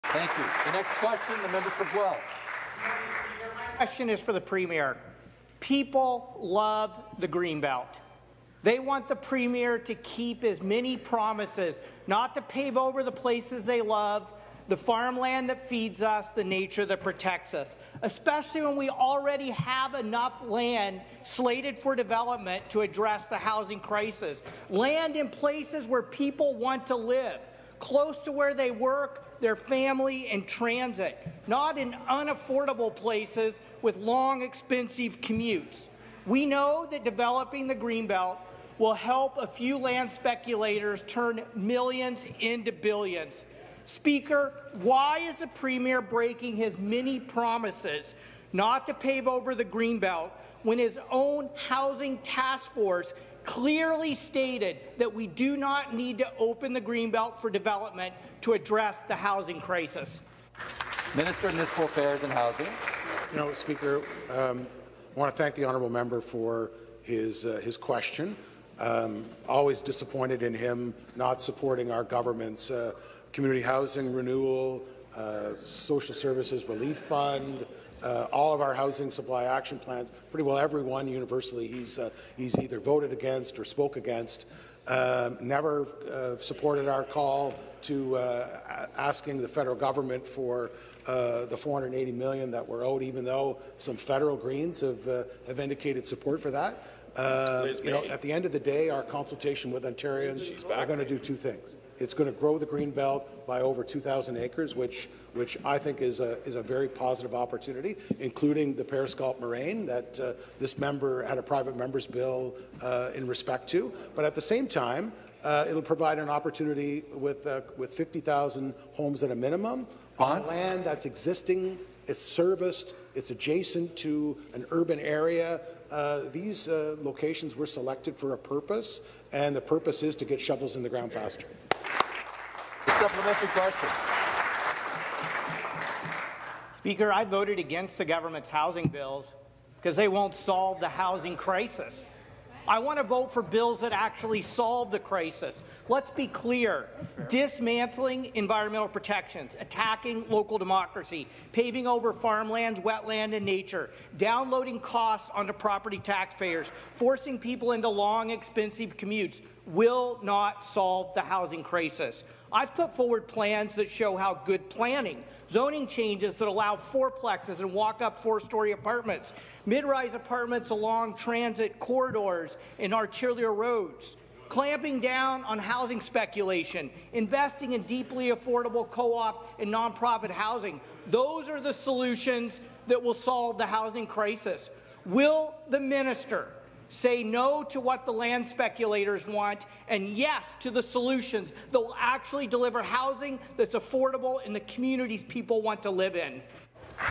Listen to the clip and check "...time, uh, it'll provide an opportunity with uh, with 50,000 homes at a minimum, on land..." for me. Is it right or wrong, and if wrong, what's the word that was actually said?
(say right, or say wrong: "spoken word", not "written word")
right.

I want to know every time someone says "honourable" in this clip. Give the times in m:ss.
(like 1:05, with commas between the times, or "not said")
1:05.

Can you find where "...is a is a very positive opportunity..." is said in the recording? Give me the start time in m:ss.
1:46.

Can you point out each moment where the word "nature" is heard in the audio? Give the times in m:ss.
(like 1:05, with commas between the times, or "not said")
0:16, 2:33.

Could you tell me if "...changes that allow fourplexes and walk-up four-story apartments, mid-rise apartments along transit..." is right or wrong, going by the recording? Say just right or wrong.
right.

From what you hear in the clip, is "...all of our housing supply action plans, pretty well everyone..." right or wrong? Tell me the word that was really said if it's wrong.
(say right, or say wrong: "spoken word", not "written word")
right.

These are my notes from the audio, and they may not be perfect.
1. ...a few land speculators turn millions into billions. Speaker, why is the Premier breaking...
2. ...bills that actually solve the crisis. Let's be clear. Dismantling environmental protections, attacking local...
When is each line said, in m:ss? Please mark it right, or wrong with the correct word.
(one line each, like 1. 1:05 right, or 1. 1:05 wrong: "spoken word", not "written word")
1. 0:39 right
2. 2:23 right.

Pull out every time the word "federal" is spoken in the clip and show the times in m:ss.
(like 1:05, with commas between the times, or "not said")
1:29, 1:33.